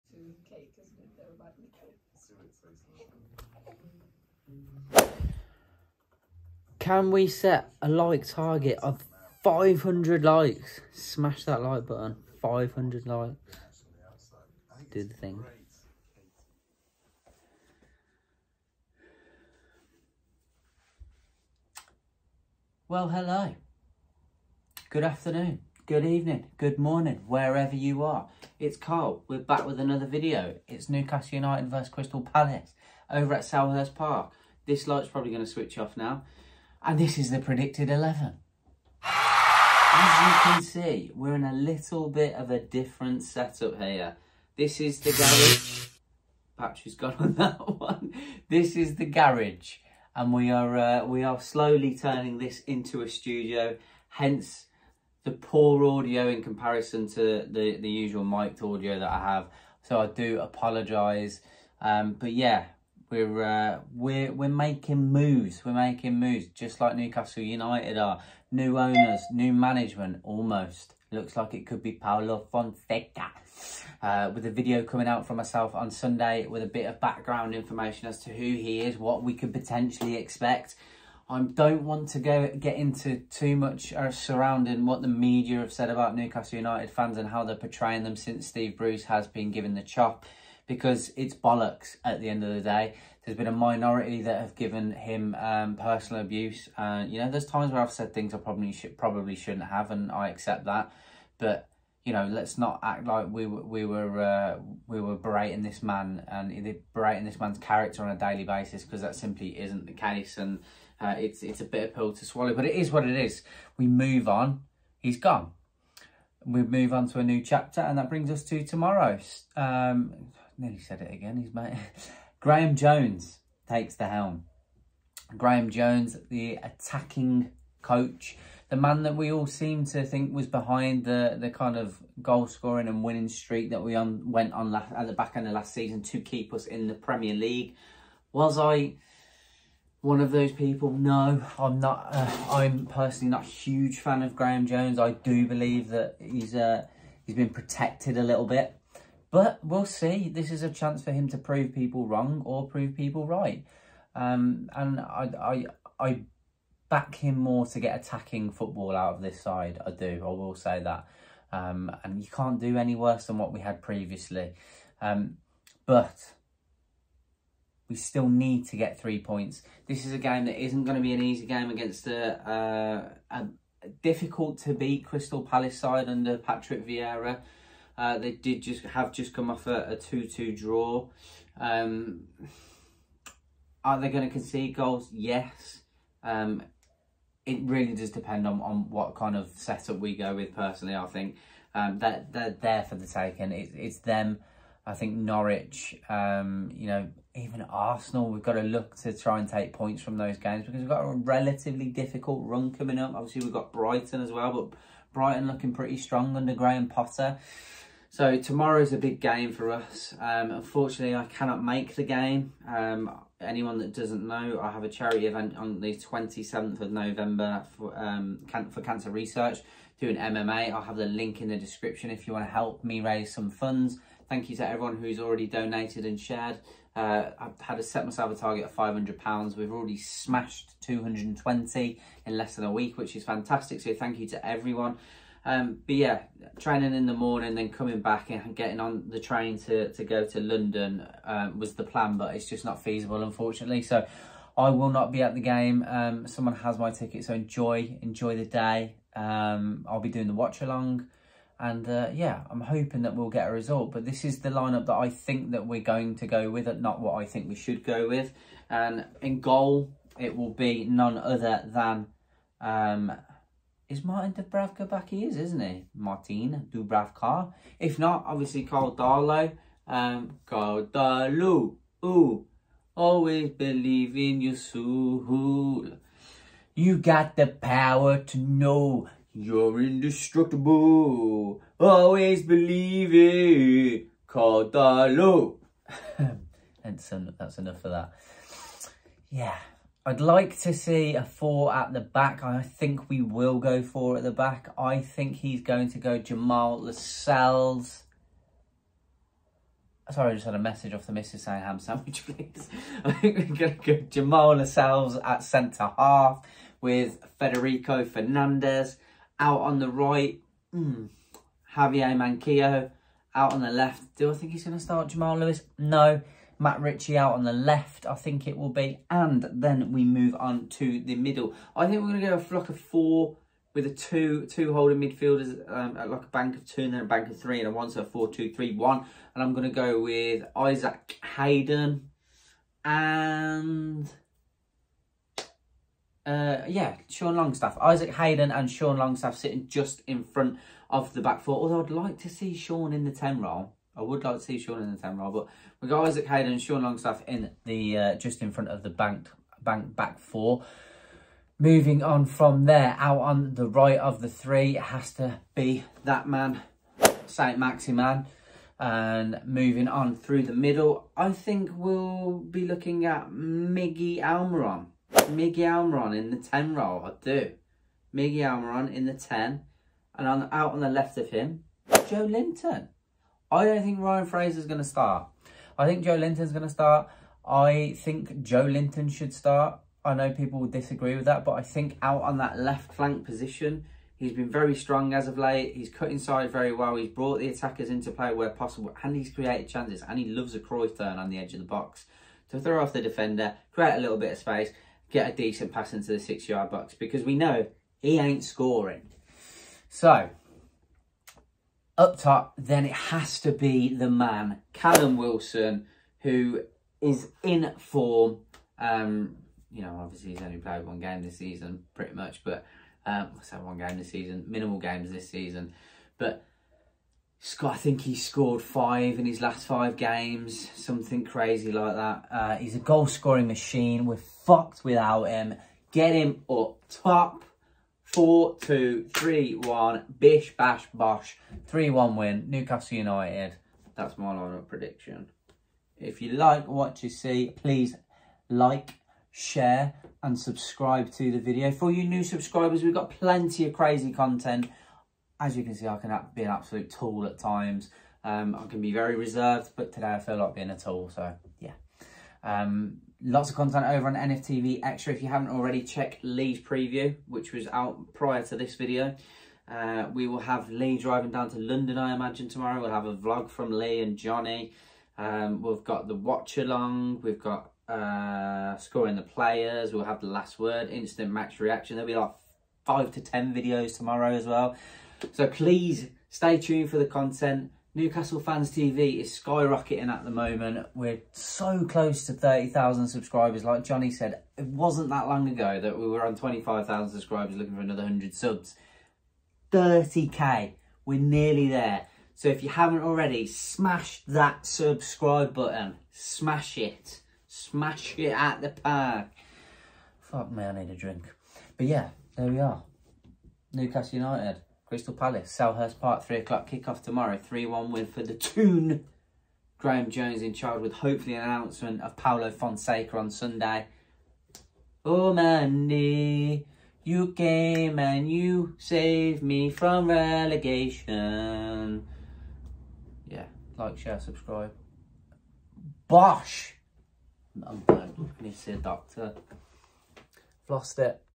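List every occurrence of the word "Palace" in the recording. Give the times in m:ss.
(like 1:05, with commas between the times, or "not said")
0:32, 2:55, 8:25.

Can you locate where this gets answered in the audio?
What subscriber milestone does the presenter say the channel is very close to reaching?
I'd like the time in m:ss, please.
8:02.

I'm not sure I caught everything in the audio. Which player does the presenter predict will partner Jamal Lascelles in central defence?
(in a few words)
Federico Fernandez.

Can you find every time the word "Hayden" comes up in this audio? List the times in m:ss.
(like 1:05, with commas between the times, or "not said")
5:31, 5:38, 5:46.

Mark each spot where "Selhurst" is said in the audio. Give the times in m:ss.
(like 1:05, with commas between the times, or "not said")
0:33, 8:25.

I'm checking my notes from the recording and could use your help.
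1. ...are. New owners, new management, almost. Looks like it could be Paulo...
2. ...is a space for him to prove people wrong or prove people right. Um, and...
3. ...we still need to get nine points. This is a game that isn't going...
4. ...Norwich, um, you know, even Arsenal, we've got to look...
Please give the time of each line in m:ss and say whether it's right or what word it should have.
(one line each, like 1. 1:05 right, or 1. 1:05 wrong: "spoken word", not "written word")
1. 1:07 right
2. 2:30 wrong: "chance", not "space"
3. 2:47 wrong: "three", not "nine"
4. 3:15 right.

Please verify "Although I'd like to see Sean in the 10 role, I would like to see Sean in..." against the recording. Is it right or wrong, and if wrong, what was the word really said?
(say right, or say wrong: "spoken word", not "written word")
right.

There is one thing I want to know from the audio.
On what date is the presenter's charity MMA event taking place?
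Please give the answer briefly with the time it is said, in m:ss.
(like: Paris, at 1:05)
27th of November, at 3:35.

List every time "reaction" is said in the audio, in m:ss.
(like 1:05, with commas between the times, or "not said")
7:51.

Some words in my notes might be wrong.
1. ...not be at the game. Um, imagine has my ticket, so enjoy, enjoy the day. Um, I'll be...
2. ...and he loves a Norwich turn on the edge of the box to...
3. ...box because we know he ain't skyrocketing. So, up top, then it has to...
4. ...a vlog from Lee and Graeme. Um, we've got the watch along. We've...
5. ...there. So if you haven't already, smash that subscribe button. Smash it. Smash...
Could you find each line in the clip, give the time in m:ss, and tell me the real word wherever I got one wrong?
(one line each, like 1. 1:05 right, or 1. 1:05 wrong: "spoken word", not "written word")
1. 4:04 wrong: "someone", not "imagine"
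2. 6:30 wrong: "Cruyff", not "Norwich"
3. 6:36 wrong: "scoring", not "skyrocketing"
4. 7:43 wrong: "Johnny", not "Graeme"
5. 8:11 right.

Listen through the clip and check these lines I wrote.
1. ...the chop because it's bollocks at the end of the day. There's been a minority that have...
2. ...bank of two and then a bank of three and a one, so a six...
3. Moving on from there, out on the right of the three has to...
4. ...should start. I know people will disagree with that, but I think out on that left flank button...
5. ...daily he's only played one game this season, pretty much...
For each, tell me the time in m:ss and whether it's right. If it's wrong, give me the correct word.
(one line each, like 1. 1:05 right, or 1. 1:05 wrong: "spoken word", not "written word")
1. 1:29 right
2. 5:26 wrong: "four", not "six"
3. 5:51 right
4. 6:19 wrong: "position", not "button"
5. 6:50 wrong: "obviously", not "daily".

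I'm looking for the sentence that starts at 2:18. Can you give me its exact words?
Was I one of those people.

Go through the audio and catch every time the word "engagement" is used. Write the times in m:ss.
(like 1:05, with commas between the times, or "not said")
not said.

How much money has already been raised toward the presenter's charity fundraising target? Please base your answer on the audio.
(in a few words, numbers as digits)
£220.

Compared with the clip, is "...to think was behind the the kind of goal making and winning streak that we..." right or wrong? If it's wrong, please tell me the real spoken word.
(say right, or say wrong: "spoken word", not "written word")
wrong: "scoring", not "making".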